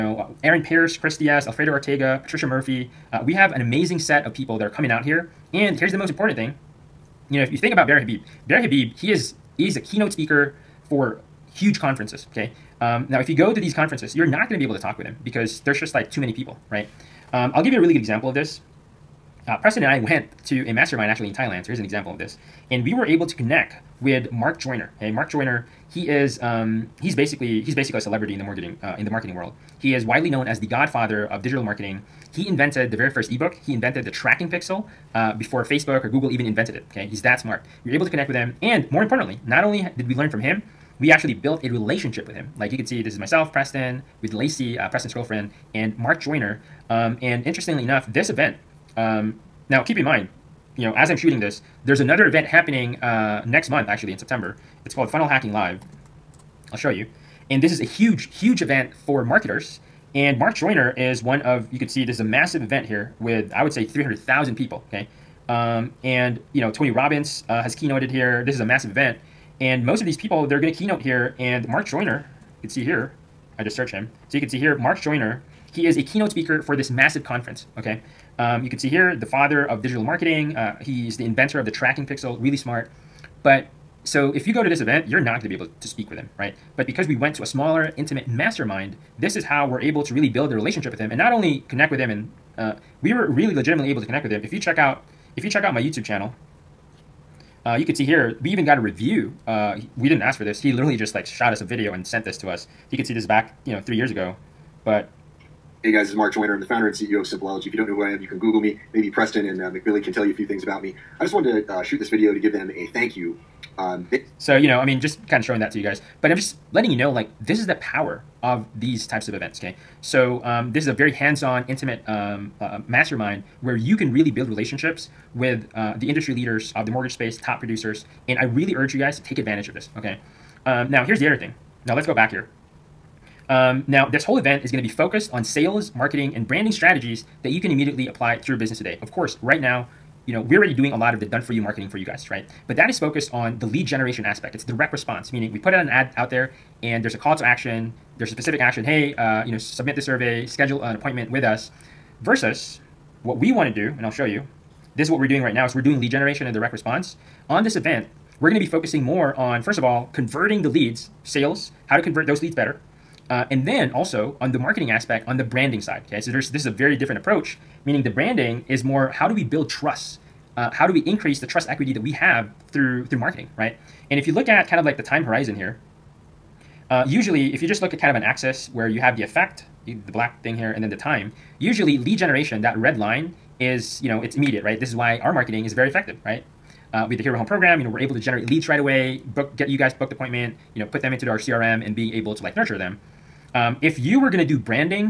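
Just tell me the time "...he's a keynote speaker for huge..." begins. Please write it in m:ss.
0:09.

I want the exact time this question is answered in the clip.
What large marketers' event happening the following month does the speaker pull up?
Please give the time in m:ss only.
0:55.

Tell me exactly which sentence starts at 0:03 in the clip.
Uh, we have an amazing set of people that are coming out here.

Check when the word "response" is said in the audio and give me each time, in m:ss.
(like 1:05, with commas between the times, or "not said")
2:24, 2:36.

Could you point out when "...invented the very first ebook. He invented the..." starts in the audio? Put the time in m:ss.
0:32.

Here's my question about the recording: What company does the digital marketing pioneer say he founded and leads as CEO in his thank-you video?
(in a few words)
Simpleology.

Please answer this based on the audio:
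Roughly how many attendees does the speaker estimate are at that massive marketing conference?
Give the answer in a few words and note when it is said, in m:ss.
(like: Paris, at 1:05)
300,000, at 1:03.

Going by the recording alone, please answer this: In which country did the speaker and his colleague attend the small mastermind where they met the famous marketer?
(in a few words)
Thailand.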